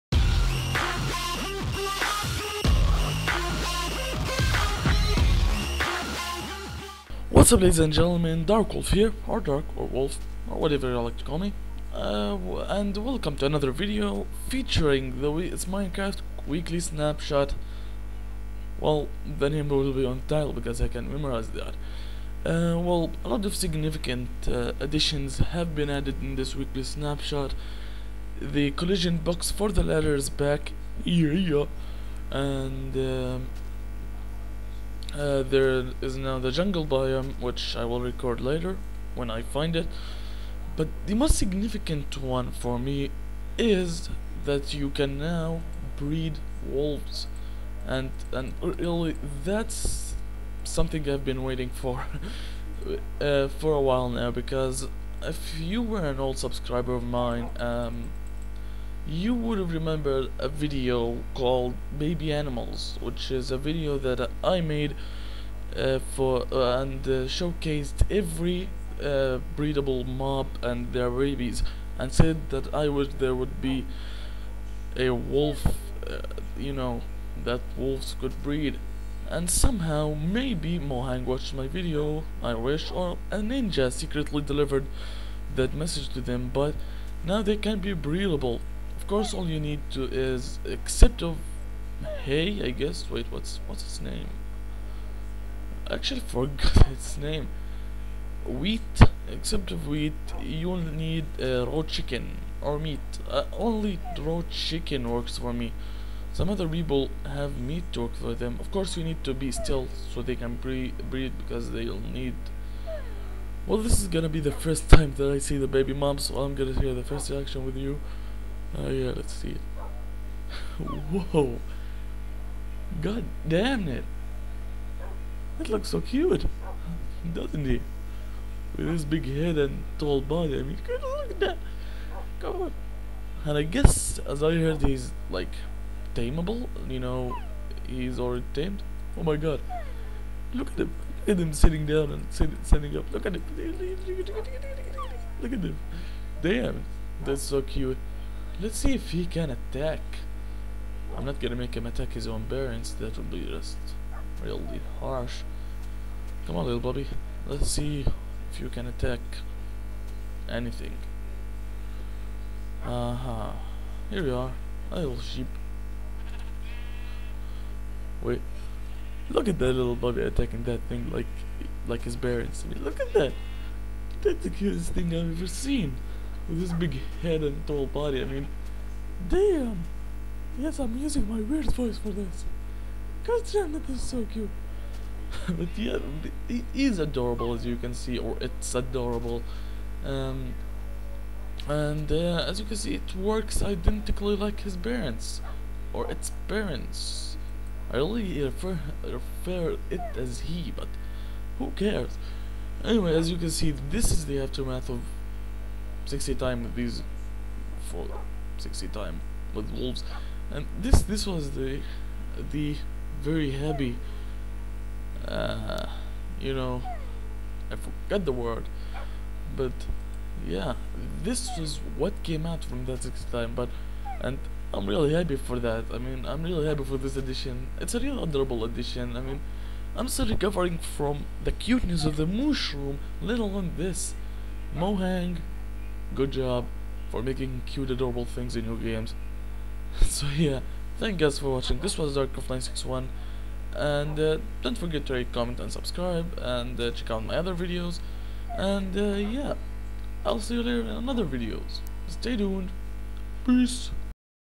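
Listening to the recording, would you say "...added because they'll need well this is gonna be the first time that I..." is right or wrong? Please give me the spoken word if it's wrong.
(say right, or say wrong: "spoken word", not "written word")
wrong: "breed", not "added".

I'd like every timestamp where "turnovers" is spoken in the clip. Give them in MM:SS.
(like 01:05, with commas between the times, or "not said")
not said.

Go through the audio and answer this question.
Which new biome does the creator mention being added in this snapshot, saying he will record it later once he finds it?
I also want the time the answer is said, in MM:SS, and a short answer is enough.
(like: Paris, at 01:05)
jungle biome, at 00:36.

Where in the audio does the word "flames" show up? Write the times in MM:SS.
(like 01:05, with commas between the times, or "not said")
not said.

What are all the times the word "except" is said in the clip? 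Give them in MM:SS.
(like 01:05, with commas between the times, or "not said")
01:30, 01:39.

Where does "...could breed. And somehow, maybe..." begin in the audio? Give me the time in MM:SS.
01:18.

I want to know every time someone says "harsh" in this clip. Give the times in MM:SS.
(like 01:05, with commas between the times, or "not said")
02:34.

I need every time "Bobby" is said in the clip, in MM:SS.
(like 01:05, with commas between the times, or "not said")
02:36, 02:49.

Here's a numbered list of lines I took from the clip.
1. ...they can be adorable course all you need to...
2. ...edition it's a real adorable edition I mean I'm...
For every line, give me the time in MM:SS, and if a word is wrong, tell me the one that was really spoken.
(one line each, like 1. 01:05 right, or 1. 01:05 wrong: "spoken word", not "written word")
1. 01:27 wrong: "breedable", not "adorable"
2. 03:47 right.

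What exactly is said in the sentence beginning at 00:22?
Uh, well, a lot of significant uh, additions have been added in this weekly snapshot.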